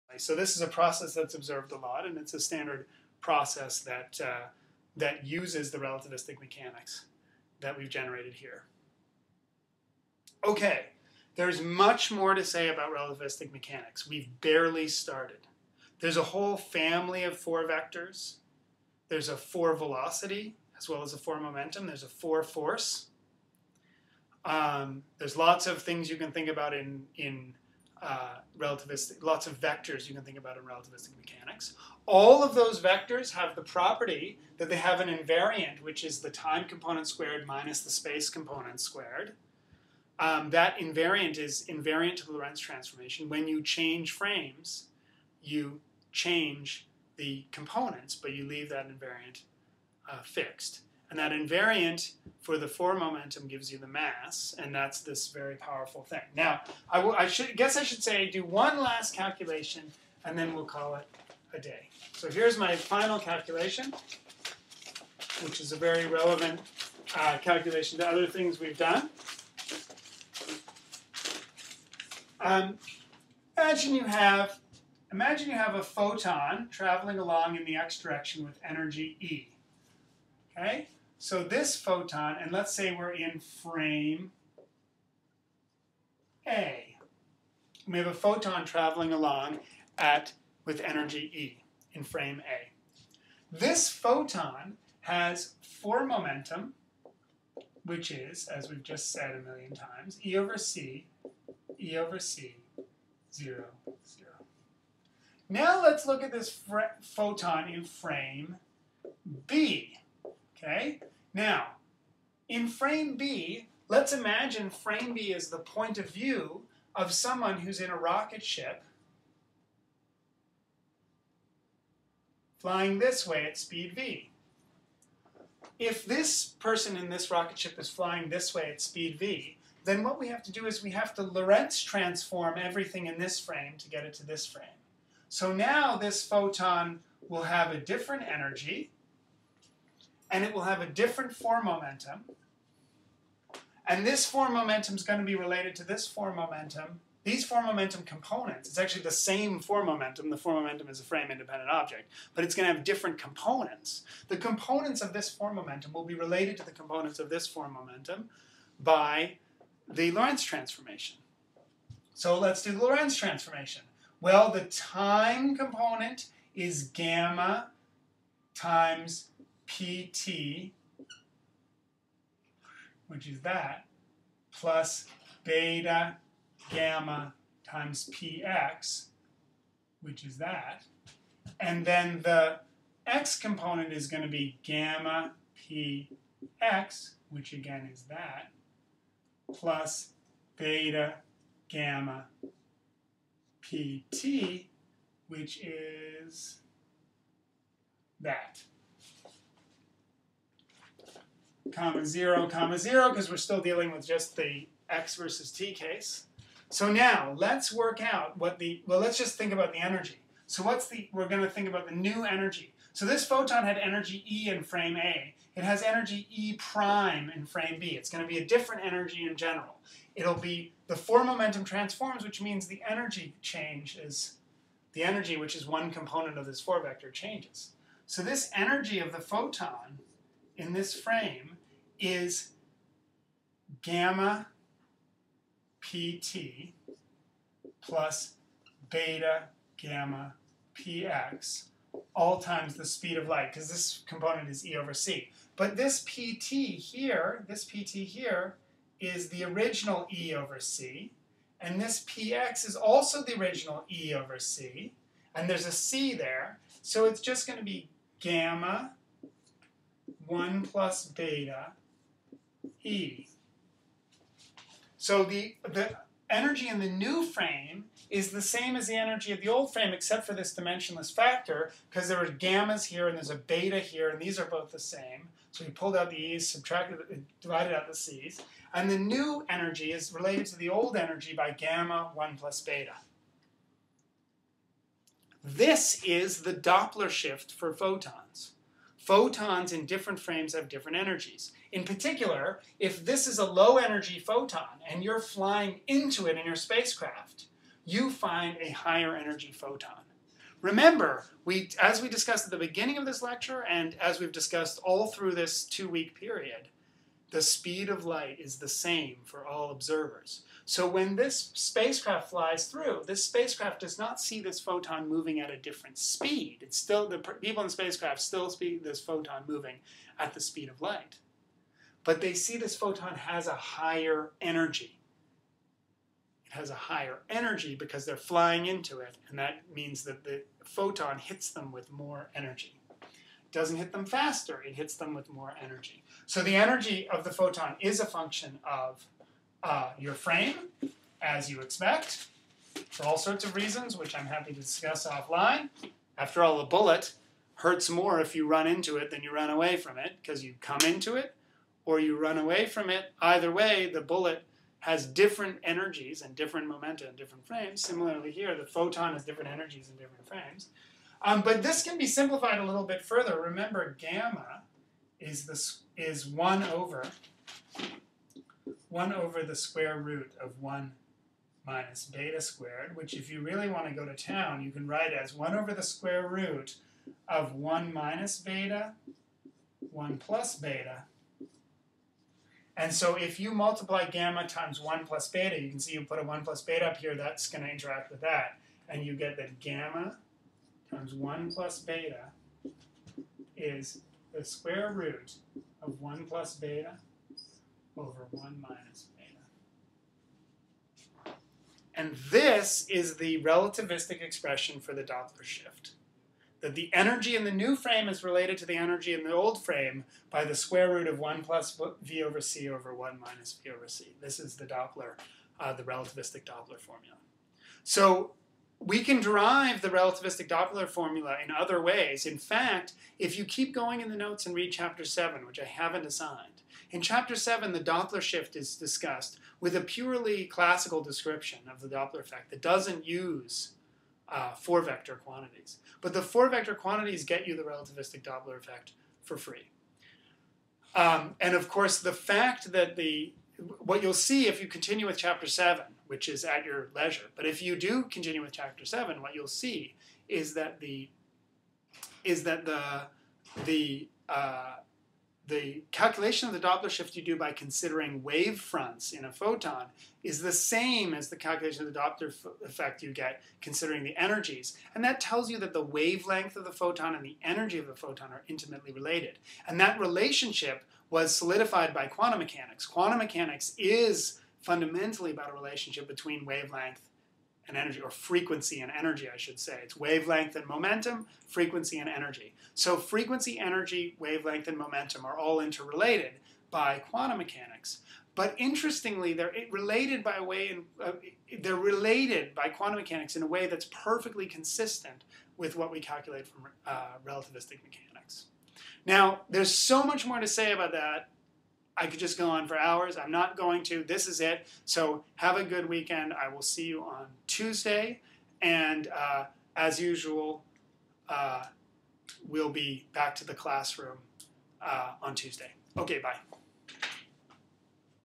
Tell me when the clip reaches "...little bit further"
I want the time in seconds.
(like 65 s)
362 s.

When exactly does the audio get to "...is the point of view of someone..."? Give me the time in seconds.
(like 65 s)
115 s.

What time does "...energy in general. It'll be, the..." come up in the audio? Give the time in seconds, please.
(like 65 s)
218 s.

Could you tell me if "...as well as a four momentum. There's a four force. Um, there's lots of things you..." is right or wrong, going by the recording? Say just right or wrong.
right.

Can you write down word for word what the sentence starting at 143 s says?
And this four momentum is going to be related to this four momentum.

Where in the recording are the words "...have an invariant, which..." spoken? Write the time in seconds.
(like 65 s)
34 s.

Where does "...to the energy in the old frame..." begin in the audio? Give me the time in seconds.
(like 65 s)
408 s.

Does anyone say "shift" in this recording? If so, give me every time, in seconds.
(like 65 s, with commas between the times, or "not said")
287 s, 405 s, 428 s, 456 s.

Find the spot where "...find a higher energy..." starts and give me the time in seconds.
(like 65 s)
298 s.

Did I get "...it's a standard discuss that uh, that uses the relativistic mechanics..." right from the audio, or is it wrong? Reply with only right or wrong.
wrong.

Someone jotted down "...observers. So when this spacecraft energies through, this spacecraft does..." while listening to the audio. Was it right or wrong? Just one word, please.
wrong.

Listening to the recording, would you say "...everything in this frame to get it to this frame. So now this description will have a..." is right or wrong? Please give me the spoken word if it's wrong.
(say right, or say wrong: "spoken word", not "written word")
wrong: "photon", not "description".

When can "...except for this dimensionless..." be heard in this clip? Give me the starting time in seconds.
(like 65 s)
269 s.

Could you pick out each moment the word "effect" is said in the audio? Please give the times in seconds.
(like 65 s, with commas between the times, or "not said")
432 s, 438 s, 462 s.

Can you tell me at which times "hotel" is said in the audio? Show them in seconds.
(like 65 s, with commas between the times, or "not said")
not said.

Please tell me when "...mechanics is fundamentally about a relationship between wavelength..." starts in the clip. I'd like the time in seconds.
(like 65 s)
473 s.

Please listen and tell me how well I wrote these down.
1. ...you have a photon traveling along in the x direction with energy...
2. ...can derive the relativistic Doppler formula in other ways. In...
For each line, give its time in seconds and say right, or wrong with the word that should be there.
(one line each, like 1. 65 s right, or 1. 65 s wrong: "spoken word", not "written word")
1. 75 s right
2. 419 s right.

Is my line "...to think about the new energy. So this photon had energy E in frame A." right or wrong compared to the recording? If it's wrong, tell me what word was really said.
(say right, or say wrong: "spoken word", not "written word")
right.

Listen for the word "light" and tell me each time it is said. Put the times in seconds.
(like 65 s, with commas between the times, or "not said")
243 s, 308 s, 320 s.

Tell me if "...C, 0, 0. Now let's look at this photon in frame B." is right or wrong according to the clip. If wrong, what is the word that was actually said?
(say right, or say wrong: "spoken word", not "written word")
right.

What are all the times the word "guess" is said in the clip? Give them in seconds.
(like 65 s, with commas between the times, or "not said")
57 s.